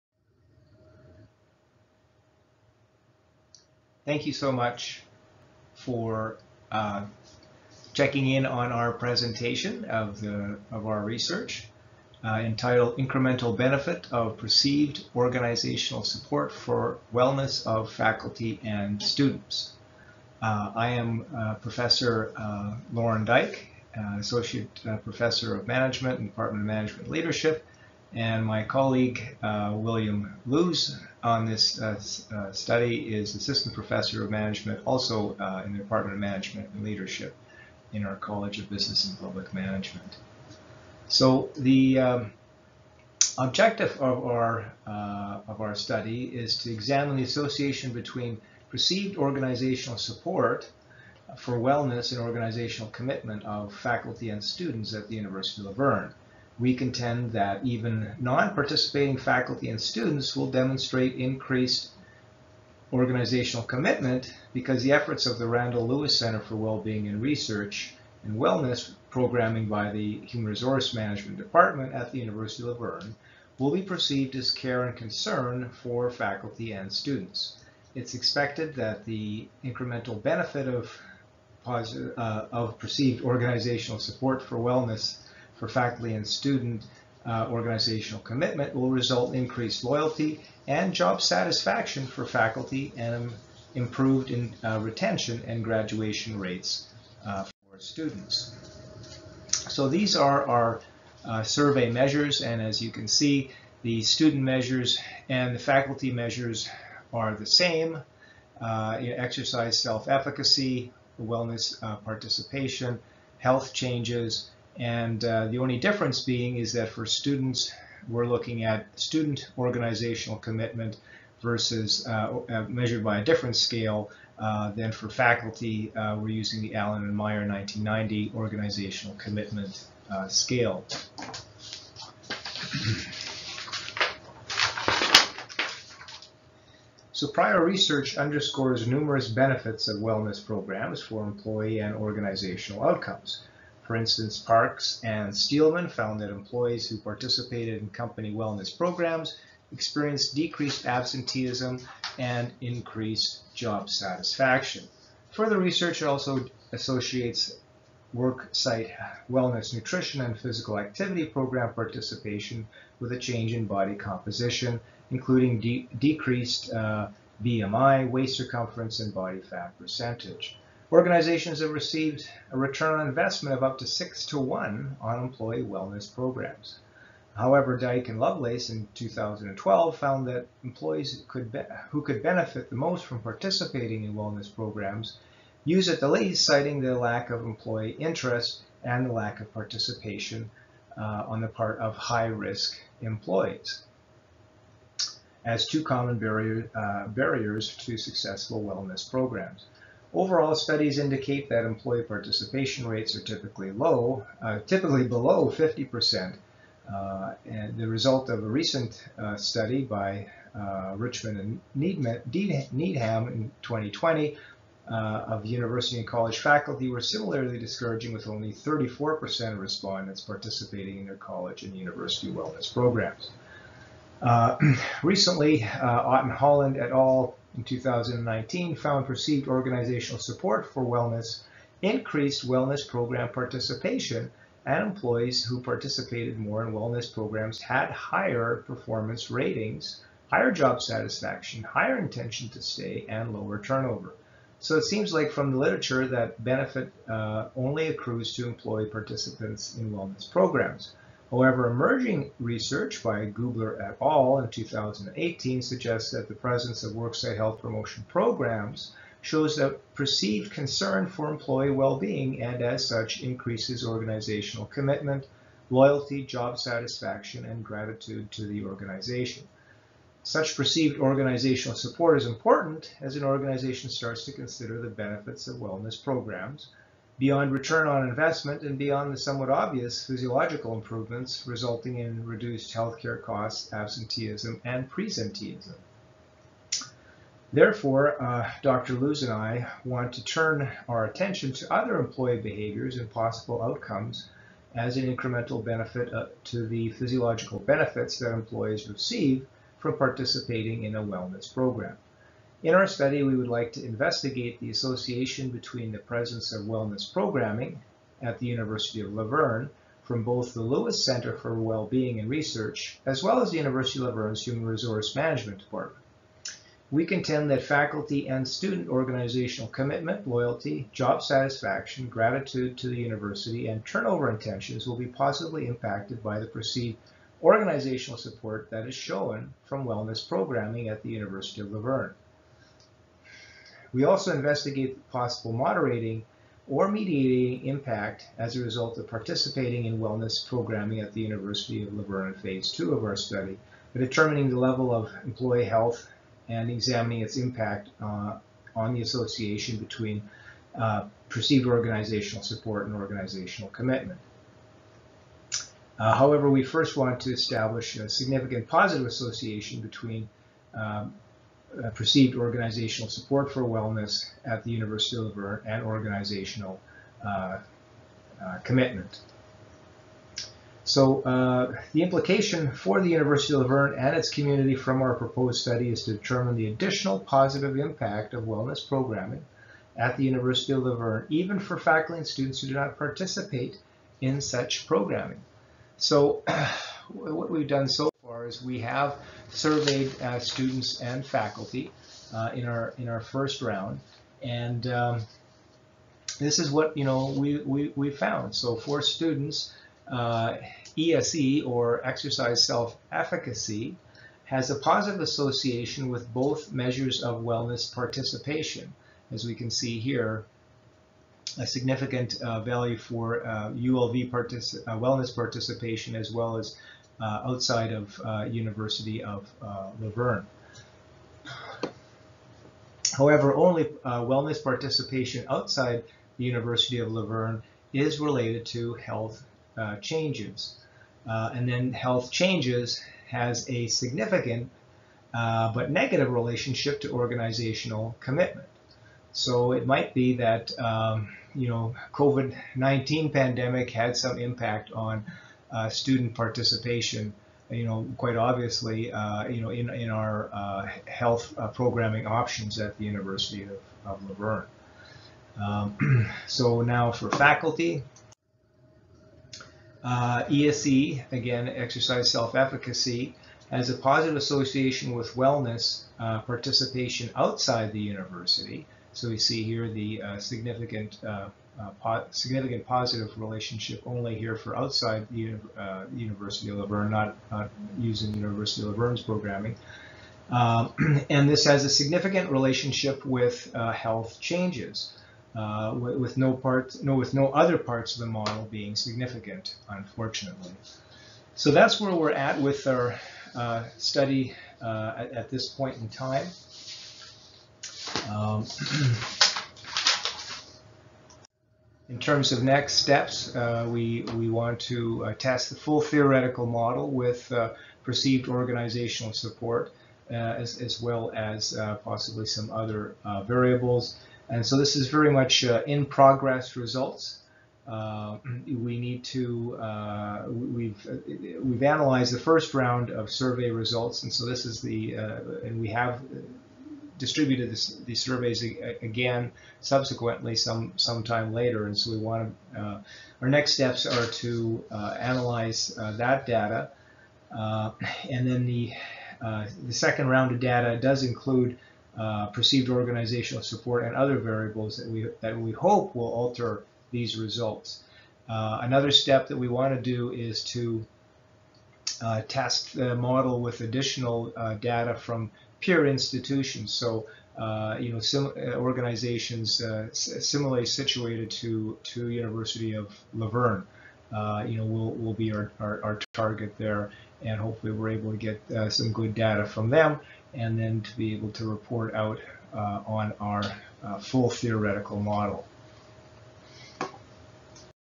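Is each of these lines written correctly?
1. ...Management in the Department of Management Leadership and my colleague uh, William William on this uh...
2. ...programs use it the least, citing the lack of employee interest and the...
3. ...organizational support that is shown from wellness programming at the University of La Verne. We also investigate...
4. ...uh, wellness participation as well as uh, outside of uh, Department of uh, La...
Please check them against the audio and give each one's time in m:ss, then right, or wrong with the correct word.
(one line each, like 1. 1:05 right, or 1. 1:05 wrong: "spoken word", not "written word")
1. 0:25 wrong: "Luse", not "William"
2. 3:04 right
3. 5:27 right
4. 6:54 wrong: "University", not "Department".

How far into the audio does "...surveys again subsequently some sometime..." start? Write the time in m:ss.
8:48.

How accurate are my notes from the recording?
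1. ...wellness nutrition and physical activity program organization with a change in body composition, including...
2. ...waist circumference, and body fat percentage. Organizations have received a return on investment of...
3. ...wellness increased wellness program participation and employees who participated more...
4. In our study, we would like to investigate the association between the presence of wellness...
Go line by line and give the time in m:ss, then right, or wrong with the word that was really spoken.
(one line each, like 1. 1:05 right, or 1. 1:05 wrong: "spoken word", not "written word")
1. 2:39 wrong: "participation", not "organization"
2. 2:48 right
3. 3:50 right
4. 5:02 right.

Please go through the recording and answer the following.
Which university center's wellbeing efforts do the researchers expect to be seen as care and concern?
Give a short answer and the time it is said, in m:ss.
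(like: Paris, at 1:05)
Randall Lewis Center for Wellbeing and Research, at 1:05.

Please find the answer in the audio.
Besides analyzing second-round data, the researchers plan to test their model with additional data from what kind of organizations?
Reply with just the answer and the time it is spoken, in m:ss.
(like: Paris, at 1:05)
peer institutions, at 9:15.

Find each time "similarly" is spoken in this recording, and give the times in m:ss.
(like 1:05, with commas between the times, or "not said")
3:36, 9:20.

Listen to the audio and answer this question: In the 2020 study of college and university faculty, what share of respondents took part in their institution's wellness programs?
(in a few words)
34%.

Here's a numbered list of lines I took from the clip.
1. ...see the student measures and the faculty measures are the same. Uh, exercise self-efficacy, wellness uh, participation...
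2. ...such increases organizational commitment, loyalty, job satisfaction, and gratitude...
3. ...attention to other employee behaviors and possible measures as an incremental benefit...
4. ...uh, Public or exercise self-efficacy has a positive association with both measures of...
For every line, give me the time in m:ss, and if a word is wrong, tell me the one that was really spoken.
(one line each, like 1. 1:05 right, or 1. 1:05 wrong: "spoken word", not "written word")
1. 1:43 right
2. 4:22 right
3. 4:51 wrong: "outcomes", not "measures"
4. 6:40 wrong: "ESE", not "Public".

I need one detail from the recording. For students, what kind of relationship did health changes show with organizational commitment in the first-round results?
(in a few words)
negative.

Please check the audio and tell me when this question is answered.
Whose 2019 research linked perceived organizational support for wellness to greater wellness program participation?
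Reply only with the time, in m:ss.
3:45.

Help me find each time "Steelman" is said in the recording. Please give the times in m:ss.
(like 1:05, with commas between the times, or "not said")
2:25.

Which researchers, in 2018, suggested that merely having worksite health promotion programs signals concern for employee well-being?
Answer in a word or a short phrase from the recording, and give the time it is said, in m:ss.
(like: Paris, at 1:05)
Gubler et al., at 4:13.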